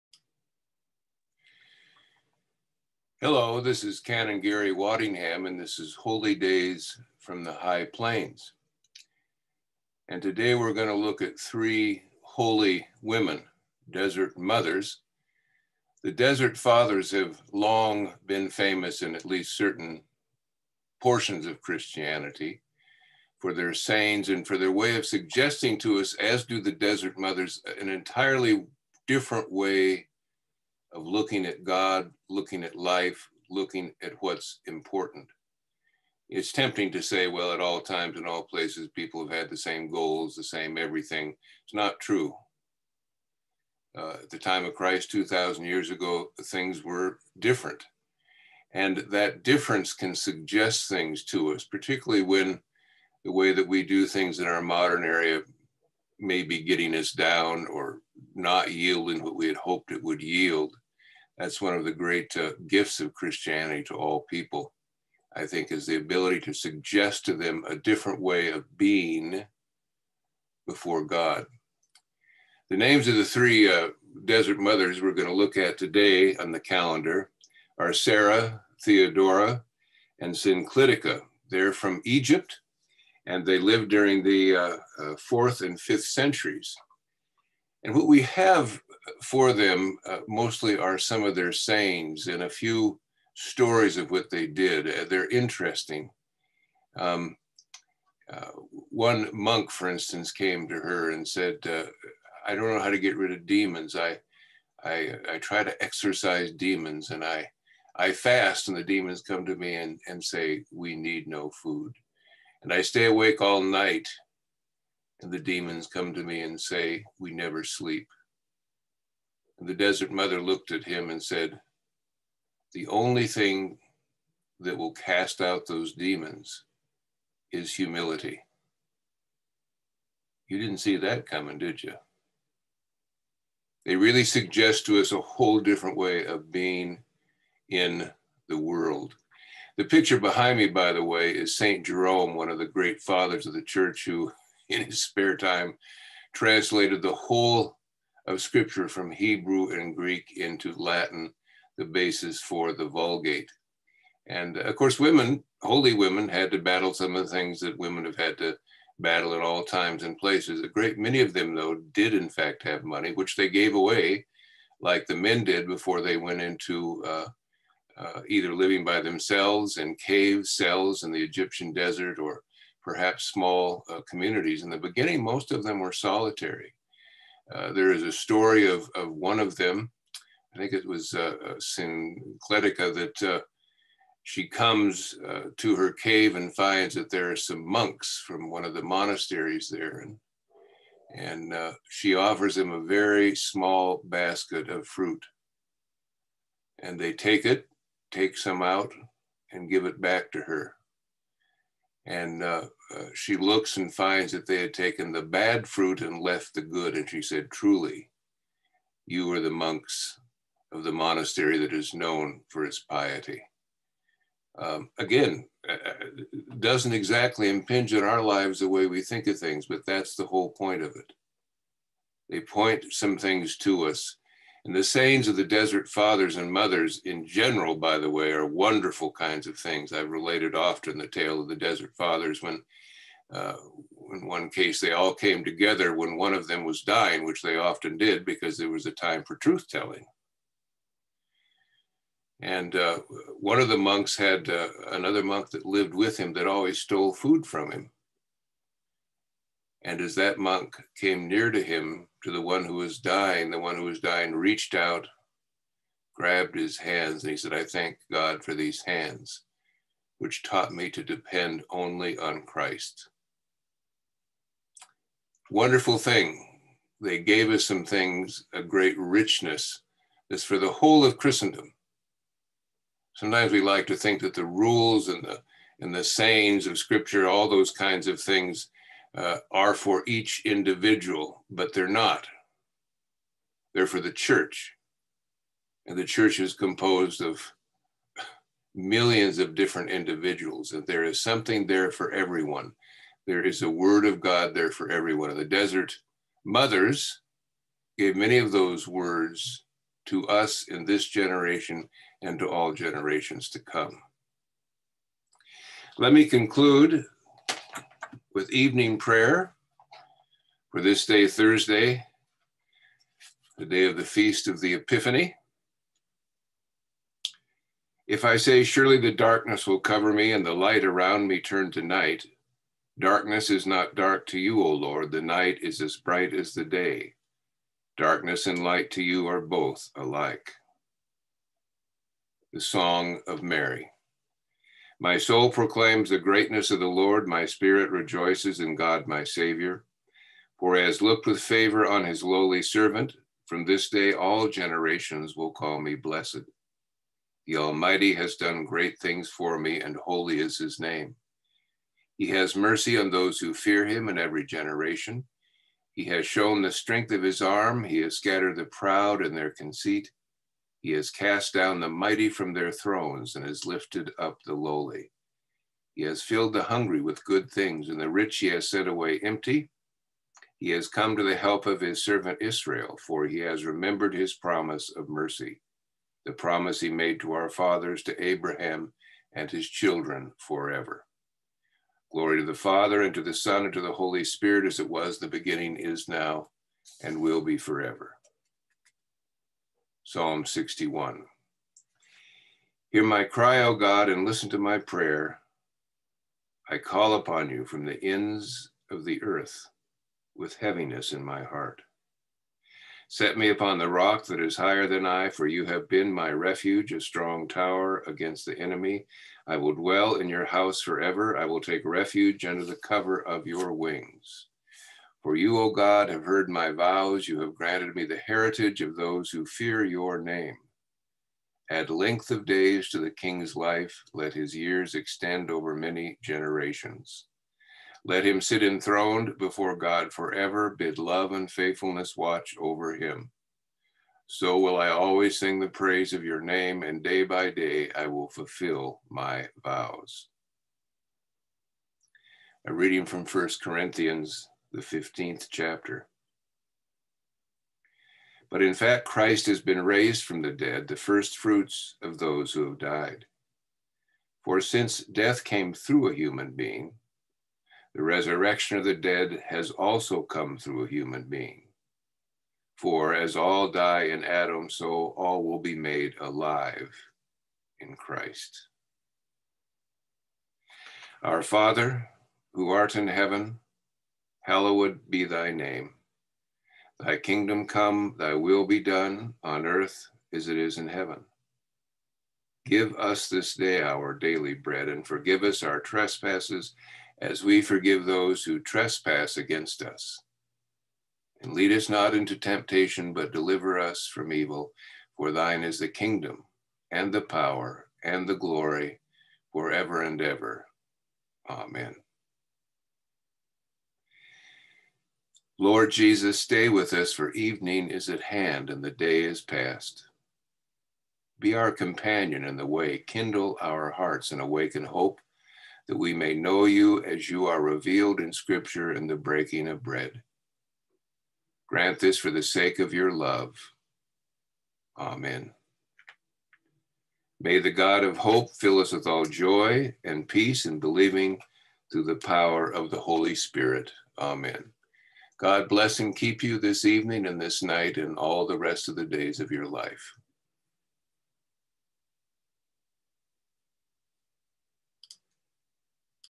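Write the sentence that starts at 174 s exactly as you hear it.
In the beginning, most of them were solitary.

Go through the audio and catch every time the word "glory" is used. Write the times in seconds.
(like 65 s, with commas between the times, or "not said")
382 s, 498 s.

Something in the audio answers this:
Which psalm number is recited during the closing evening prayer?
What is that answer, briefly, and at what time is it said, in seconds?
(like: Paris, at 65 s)
61, at 390 s.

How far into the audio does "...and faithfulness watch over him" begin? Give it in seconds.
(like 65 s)
431 s.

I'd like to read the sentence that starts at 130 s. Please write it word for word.
You didn't see that coming, did you?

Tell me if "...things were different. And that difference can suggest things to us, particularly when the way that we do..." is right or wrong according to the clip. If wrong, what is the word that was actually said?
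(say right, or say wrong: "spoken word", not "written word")
right.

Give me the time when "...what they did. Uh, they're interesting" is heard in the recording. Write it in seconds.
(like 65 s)
94 s.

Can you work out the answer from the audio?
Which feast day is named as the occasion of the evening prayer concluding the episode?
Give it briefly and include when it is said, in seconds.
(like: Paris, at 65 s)
Feast of the Epiphany, at 314 s.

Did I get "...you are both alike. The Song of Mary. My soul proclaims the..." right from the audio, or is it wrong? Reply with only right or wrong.
right.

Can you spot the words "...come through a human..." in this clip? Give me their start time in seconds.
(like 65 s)
460 s.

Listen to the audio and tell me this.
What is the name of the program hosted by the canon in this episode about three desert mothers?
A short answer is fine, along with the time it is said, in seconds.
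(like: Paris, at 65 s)
Holy Days from the High Plains, at 5 s.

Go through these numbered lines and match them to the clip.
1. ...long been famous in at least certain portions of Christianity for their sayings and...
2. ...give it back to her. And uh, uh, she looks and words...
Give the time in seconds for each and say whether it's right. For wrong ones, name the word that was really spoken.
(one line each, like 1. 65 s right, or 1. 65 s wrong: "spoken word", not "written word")
1. 17 s right
2. 199 s wrong: "finds", not "words".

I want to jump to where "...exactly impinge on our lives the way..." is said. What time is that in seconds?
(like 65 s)
216 s.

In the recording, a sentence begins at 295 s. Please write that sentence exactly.
In the desert, mothers gave many of those words to us in this generation and to all generations to come.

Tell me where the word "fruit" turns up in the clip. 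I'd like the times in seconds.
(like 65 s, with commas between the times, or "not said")
194 s, 205 s, 451 s.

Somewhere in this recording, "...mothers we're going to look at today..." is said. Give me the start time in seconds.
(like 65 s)
74 s.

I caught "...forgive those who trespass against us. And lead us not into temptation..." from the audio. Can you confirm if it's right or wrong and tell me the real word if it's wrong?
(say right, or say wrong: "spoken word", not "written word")
right.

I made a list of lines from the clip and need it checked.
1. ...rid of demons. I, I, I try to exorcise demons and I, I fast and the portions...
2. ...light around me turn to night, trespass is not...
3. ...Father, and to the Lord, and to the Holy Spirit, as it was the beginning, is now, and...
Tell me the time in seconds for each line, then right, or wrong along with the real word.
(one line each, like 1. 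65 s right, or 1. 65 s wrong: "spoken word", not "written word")
1. 103 s wrong: "demons", not "portions"
2. 320 s wrong: "darkness", not "trespass"
3. 382 s wrong: "Son", not "Lord".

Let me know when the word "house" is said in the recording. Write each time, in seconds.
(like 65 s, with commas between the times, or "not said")
410 s.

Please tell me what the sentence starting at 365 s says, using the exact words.
He has filled the hungry with good things, and the rich he has sent away empty.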